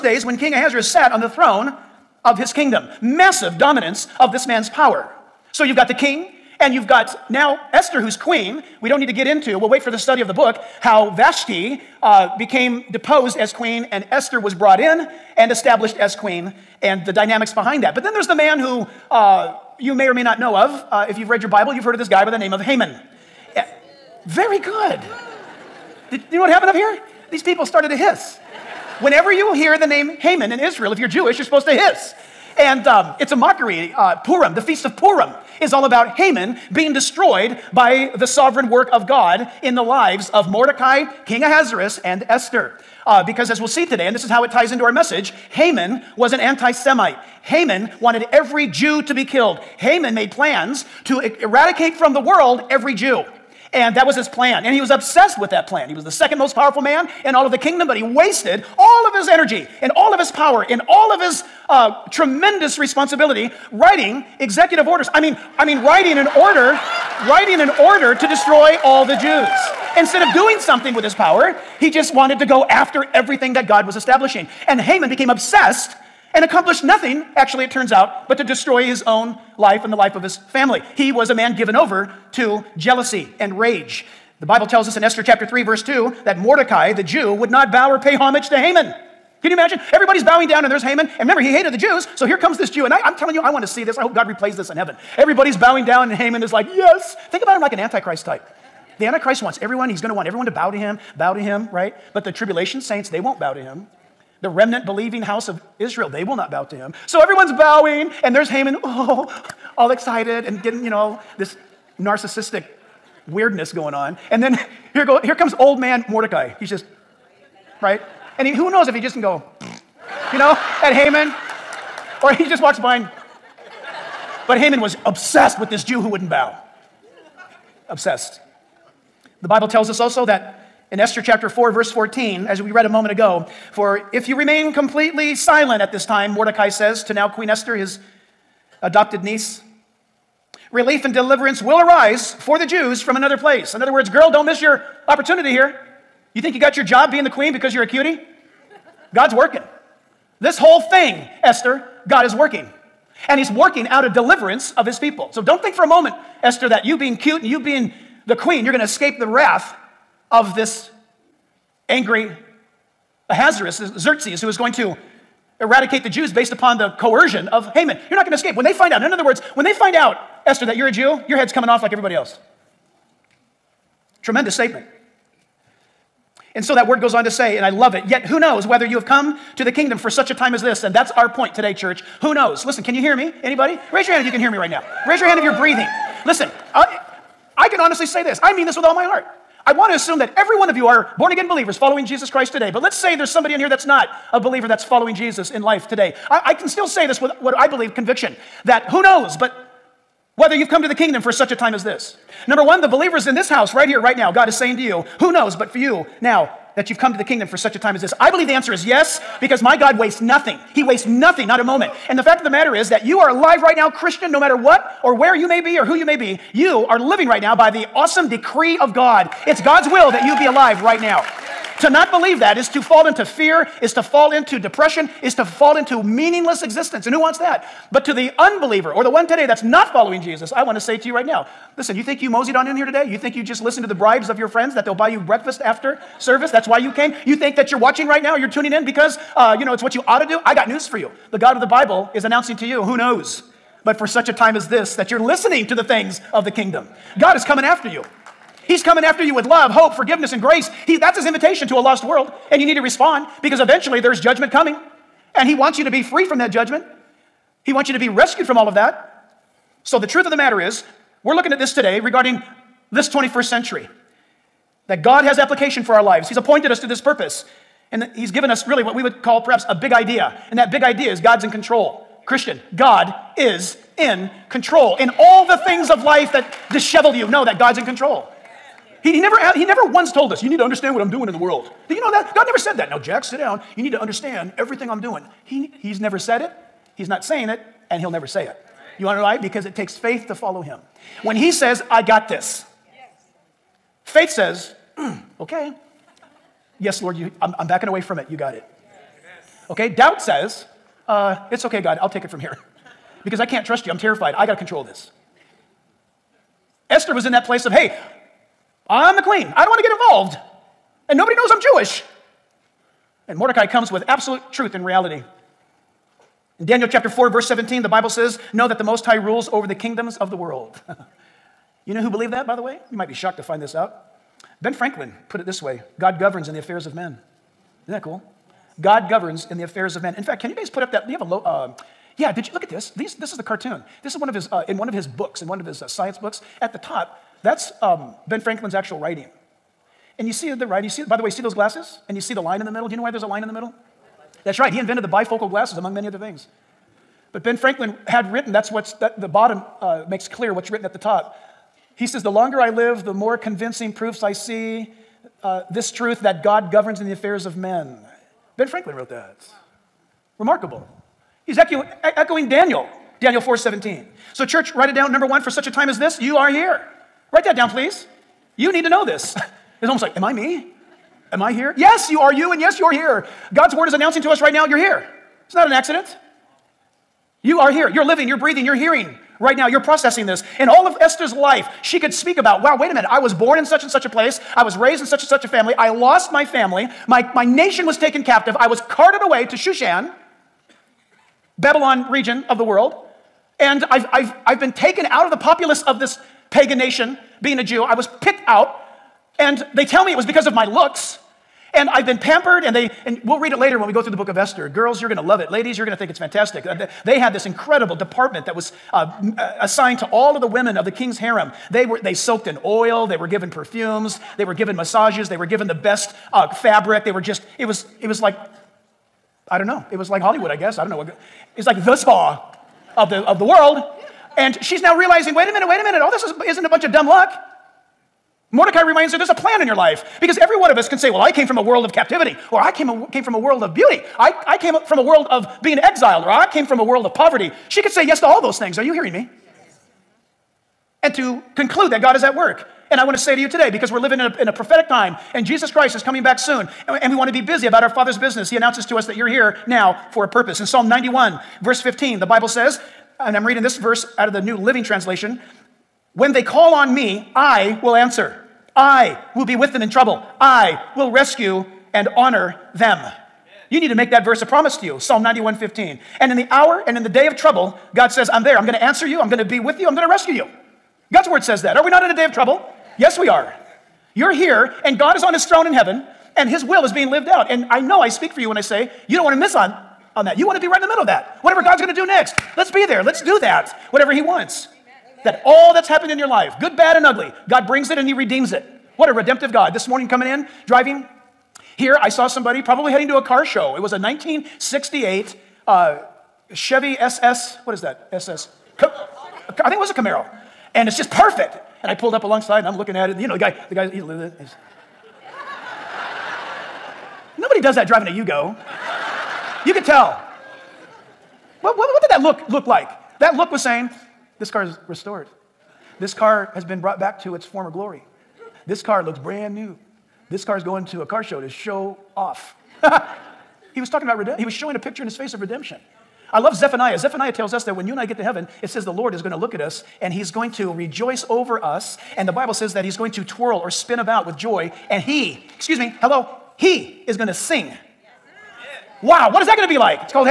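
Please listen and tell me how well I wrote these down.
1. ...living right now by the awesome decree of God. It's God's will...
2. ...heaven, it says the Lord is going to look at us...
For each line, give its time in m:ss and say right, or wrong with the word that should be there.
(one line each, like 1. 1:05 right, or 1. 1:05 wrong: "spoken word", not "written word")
1. 3:36 right
2. 8:48 right.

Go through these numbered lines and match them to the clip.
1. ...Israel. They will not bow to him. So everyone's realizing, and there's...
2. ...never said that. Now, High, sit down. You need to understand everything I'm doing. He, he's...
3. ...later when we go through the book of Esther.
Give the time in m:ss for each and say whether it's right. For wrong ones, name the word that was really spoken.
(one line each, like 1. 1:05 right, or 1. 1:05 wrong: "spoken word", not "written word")
1. 1:45 wrong: "bowing", not "realizing"
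2. 4:42 wrong: "Jack", not "High"
3. 6:43 right.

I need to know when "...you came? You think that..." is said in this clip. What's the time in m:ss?
3:56.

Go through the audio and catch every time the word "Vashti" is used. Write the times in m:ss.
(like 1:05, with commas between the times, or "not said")
0:11.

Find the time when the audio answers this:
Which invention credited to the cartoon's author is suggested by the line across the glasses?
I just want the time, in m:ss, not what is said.
5:45.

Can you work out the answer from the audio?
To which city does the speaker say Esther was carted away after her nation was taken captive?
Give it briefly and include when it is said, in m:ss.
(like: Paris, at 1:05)
Shushan, at 6:29.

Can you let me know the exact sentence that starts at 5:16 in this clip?
In Daniel chapter 4, verse 17, the Bible says, Know that the Most High rules over the kingdoms of the world.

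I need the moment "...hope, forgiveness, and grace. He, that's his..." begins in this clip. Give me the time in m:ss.
4:09.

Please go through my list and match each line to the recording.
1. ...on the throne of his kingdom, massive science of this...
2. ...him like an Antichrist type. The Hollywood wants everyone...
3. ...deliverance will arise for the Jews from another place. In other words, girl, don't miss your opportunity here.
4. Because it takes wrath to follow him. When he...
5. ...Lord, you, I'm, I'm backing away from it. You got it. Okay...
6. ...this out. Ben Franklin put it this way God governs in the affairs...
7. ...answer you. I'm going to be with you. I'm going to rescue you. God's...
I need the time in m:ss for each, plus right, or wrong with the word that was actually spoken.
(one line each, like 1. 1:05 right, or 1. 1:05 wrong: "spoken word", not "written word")
1. 0:01 wrong: "dominance", not "science"
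2. 1:37 wrong: "Antichrist", not "Hollywood"
3. 2:21 right
4. 4:49 wrong: "faith", not "wrath"
5. 4:57 right
6. 5:23 right
7. 7:48 right.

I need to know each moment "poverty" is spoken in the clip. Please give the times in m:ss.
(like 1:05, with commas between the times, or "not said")
7:17.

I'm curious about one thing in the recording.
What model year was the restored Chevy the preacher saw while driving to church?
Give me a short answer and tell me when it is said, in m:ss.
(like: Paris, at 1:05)
1968, at 8:13.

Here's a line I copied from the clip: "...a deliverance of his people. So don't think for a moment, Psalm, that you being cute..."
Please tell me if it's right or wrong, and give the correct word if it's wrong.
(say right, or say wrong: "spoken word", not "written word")
wrong: "Esther", not "Psalm".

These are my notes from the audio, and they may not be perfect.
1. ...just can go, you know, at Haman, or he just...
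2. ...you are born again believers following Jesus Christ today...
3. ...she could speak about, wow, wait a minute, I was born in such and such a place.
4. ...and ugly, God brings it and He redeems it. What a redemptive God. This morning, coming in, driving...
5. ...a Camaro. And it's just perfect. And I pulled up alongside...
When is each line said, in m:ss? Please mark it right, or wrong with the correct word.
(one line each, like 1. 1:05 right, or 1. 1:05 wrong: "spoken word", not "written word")
1. 1:58 right
2. 3:10 right
3. 6:21 right
4. 8:06 right
5. 8:19 right.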